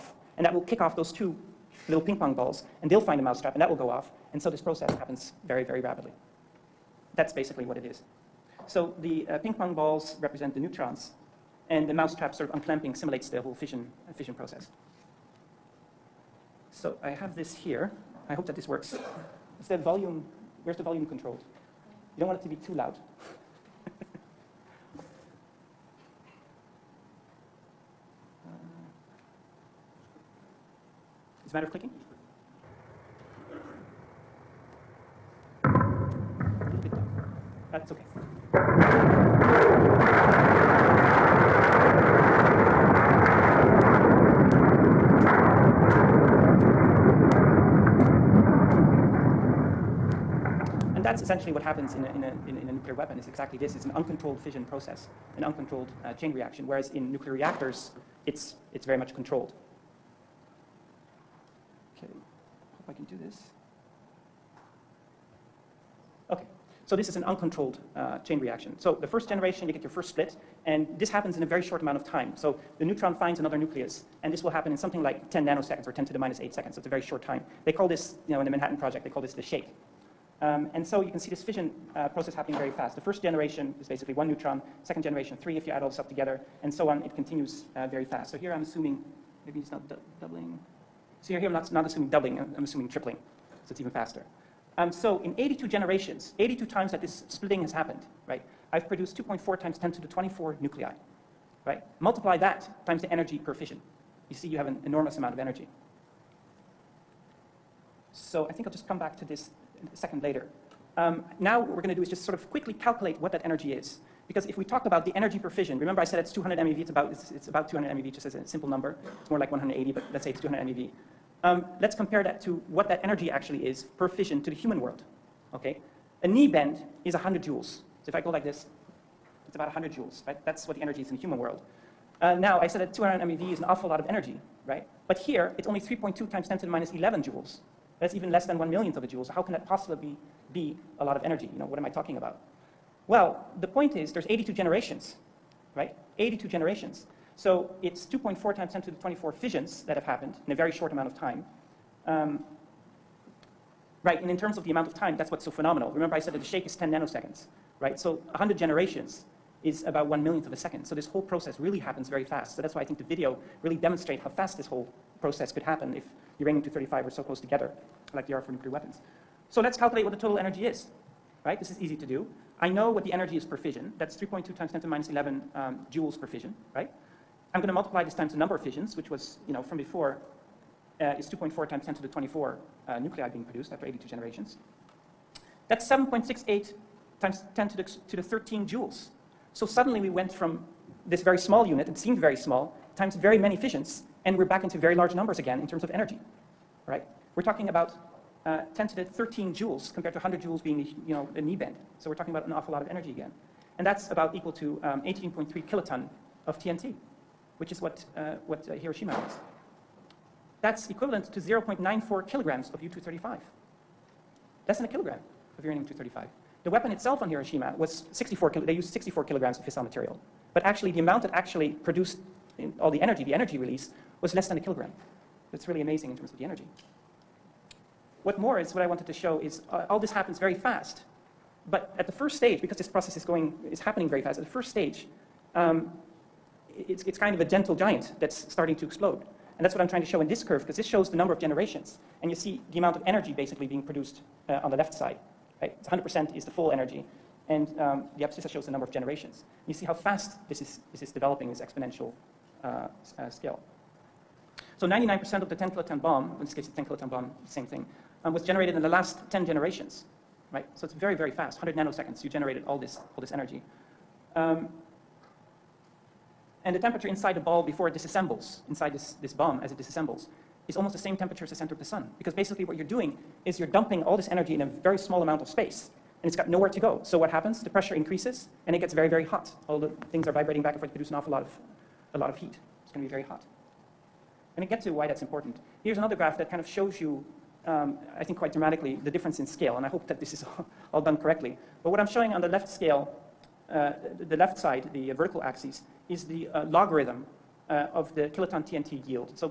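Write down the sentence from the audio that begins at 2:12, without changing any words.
Uh, now, I said that 200 MeV is an awful lot of energy, right?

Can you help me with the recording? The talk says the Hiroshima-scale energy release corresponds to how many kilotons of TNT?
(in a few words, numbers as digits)
18.3 kilotons.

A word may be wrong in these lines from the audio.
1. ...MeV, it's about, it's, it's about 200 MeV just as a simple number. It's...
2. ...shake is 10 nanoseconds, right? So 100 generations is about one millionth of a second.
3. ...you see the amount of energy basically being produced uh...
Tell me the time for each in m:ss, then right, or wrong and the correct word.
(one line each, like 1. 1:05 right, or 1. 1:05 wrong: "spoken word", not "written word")
1. 1:56 right
2. 2:36 right
3. 4:02 right.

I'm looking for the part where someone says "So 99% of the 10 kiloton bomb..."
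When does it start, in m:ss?
4:14.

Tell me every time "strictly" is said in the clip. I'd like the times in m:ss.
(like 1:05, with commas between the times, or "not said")
not said.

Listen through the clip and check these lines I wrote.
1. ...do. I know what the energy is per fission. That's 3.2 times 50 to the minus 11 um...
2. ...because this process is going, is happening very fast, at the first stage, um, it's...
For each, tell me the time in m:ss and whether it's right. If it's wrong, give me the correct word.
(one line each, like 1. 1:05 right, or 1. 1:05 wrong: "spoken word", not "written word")
1. 2:52 wrong: "10", not "50"
2. 3:52 right.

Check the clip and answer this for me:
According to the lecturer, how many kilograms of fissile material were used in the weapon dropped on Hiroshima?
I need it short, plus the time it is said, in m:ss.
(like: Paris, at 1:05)
64 kilograms, at 3:38.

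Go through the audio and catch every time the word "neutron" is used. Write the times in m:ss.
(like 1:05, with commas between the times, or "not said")
0:10, 1:12, 1:24.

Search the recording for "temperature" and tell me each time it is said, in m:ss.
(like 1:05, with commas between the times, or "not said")
4:26, 4:31.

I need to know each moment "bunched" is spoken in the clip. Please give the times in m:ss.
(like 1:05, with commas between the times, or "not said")
not said.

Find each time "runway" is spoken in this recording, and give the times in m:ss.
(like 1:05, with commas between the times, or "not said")
not said.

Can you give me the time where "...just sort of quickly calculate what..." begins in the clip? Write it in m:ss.
1:52.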